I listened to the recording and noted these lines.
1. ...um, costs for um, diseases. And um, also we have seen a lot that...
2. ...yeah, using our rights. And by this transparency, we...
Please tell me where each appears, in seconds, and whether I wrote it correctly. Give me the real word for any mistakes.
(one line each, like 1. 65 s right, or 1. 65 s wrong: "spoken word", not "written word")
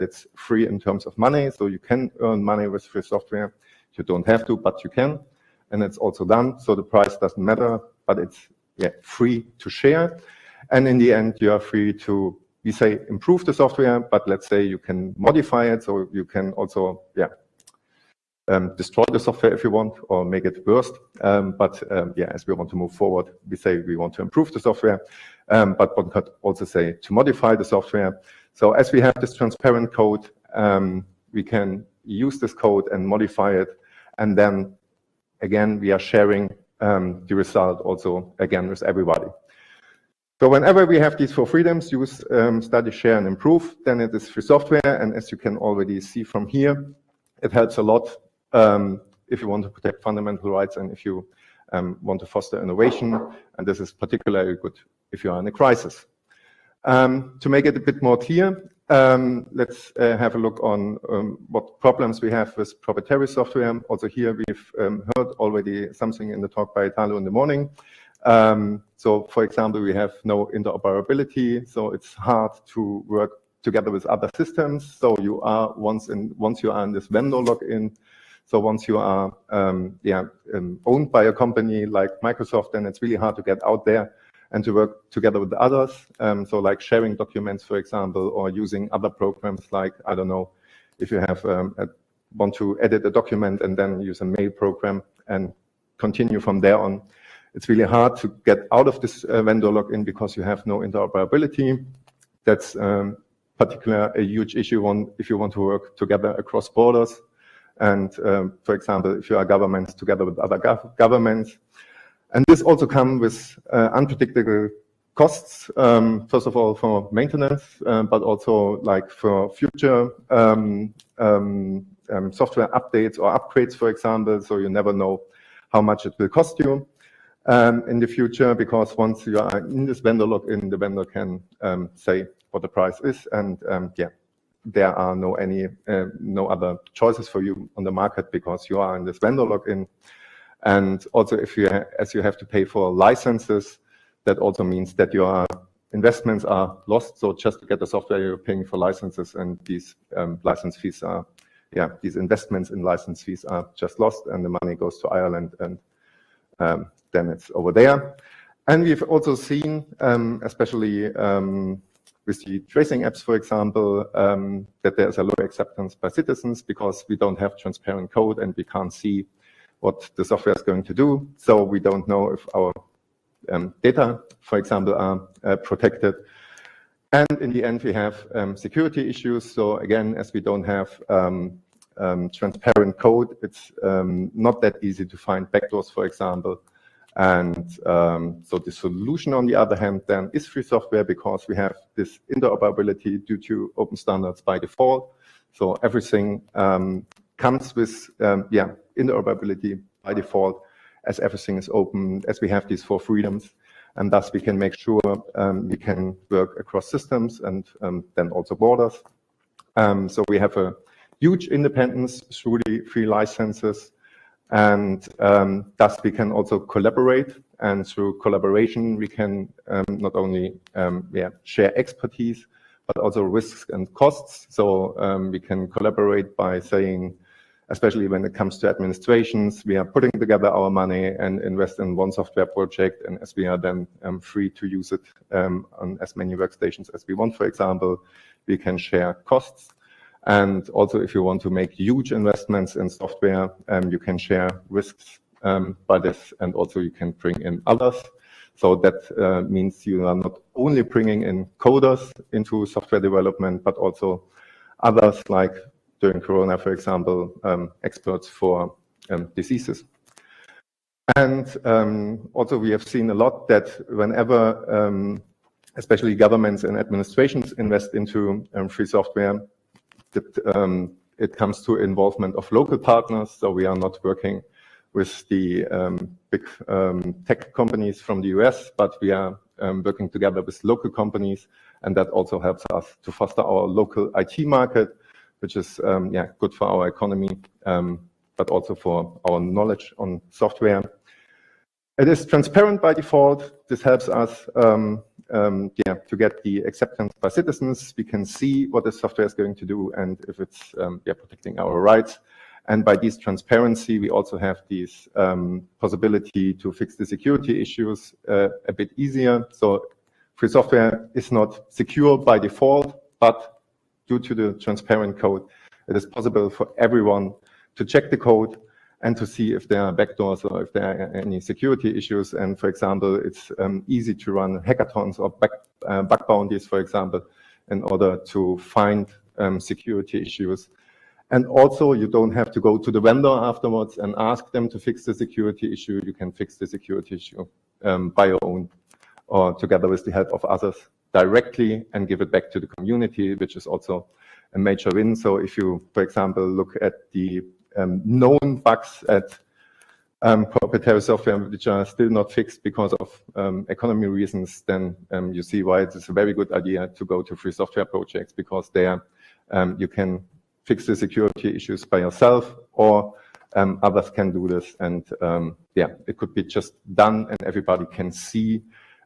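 1. 257 s wrong: "experts", not "costs"
2. 301 s wrong: "protecting", not "using".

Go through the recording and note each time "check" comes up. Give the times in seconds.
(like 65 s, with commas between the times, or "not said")
317 s.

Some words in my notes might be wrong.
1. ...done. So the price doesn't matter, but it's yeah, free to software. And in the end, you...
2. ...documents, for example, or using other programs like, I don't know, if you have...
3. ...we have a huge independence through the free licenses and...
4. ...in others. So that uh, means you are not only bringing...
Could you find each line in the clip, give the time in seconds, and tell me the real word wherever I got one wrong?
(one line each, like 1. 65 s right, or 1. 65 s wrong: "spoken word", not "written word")
1. 6 s wrong: "share", not "software"
2. 87 s right
3. 210 s right
4. 247 s right.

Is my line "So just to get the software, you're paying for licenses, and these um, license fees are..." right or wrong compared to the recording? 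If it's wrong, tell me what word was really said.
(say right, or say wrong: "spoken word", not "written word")
right.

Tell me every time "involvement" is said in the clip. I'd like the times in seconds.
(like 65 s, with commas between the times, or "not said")
271 s.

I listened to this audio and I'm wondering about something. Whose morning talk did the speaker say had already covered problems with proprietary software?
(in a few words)
Italo.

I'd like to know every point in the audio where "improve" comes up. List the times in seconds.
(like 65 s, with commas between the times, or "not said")
13 s, 24 s, 43 s.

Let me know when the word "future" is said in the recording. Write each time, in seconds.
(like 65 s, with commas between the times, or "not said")
119 s, 128 s.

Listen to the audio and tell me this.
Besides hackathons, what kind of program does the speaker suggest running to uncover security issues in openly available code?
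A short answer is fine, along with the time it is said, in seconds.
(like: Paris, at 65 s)
bug bounties, at 326 s.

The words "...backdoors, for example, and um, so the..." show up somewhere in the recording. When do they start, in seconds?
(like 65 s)
185 s.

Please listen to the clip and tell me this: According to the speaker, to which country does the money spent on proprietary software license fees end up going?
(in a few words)
Ireland.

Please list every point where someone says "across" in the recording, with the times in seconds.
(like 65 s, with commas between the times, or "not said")
106 s, 206 s.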